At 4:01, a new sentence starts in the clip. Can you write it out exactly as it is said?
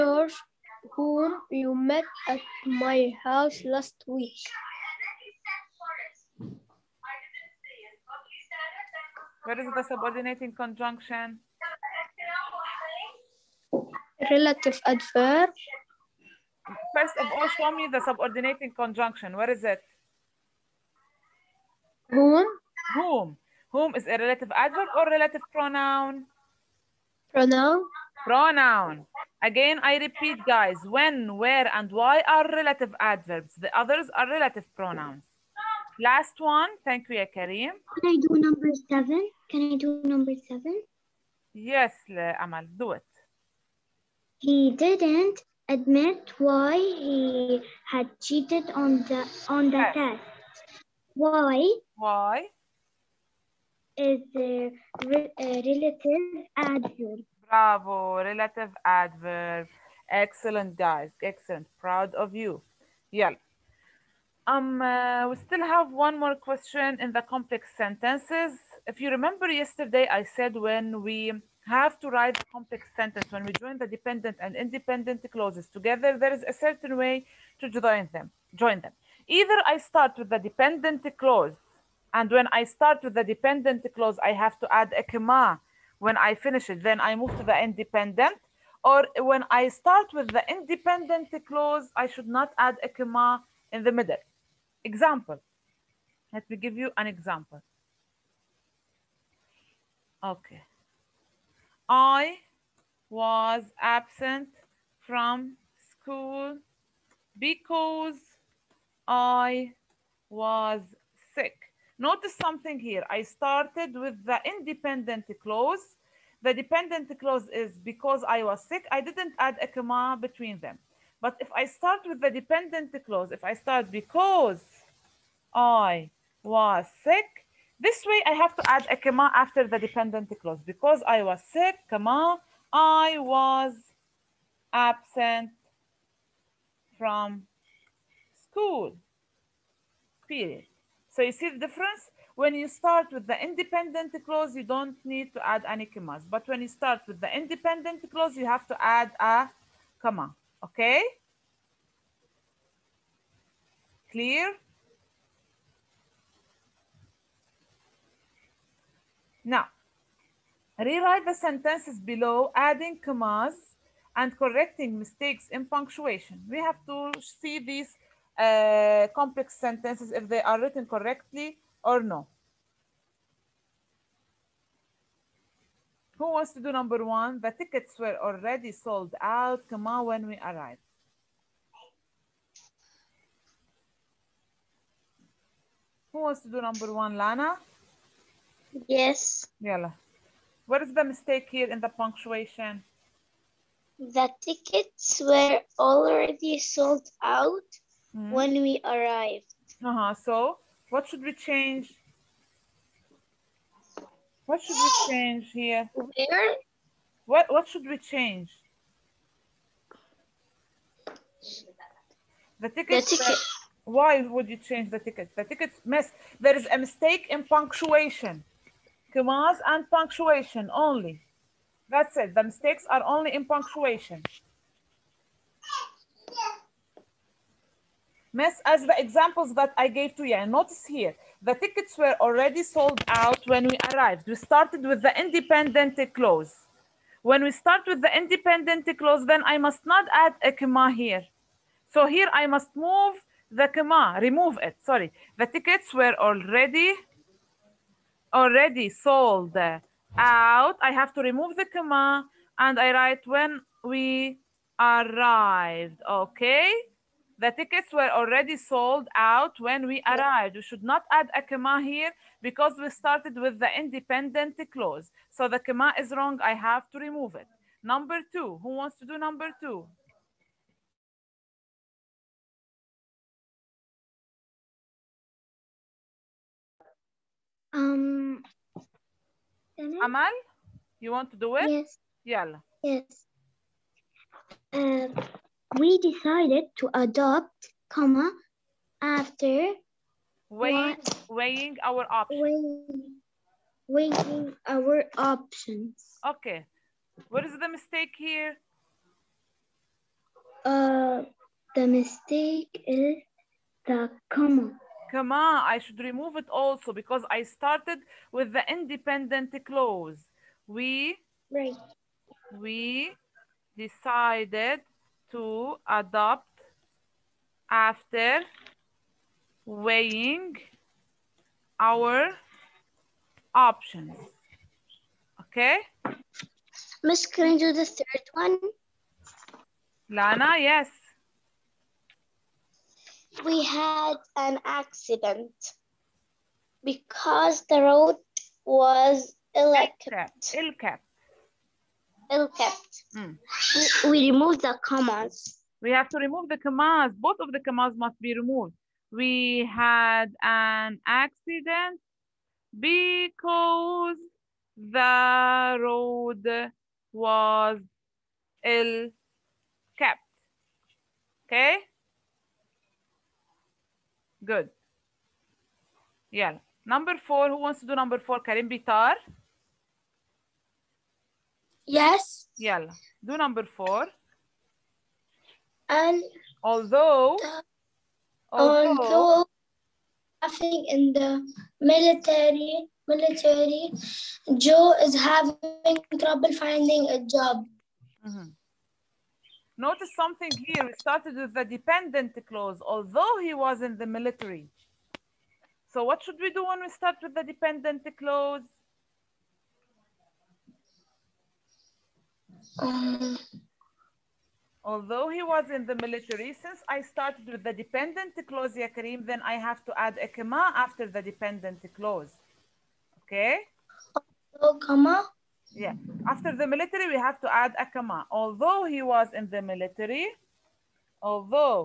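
So here I must move the comma, remove it, sorry.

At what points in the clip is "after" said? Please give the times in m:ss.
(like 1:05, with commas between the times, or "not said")
2:09, 4:49, 5:17, 6:50, 6:56.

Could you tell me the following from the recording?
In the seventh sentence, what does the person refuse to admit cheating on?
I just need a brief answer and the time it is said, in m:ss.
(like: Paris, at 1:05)
test, at 0:50.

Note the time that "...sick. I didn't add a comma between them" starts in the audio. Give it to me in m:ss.
1:58.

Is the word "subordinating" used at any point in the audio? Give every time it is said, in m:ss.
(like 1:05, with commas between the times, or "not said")
0:09, 0:18.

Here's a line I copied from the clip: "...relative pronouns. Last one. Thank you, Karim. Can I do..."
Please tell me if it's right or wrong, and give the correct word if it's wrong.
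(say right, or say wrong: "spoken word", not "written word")
right.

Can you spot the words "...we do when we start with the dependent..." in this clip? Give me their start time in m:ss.
6:36.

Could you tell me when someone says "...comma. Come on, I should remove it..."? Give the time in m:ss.
5:04.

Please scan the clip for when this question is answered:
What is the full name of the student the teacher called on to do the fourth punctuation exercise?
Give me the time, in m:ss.
6:08.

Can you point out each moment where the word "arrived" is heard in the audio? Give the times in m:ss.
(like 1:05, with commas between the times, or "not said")
3:00, 3:18, 3:53, 4:14, 4:20.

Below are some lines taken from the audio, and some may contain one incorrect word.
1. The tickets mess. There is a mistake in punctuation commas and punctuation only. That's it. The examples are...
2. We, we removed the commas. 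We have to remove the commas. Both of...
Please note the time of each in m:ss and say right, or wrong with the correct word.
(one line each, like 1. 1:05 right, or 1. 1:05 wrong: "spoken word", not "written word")
1. 3:35 wrong: "mistakes", not "examples"
2. 5:44 right.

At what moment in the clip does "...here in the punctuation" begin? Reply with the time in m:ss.
3:11.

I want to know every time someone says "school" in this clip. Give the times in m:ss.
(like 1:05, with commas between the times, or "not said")
1:45, 2:18.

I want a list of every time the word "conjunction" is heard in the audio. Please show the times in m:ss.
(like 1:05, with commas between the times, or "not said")
0:10, 0:18.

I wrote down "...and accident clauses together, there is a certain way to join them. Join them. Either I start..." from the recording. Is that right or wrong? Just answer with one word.
wrong.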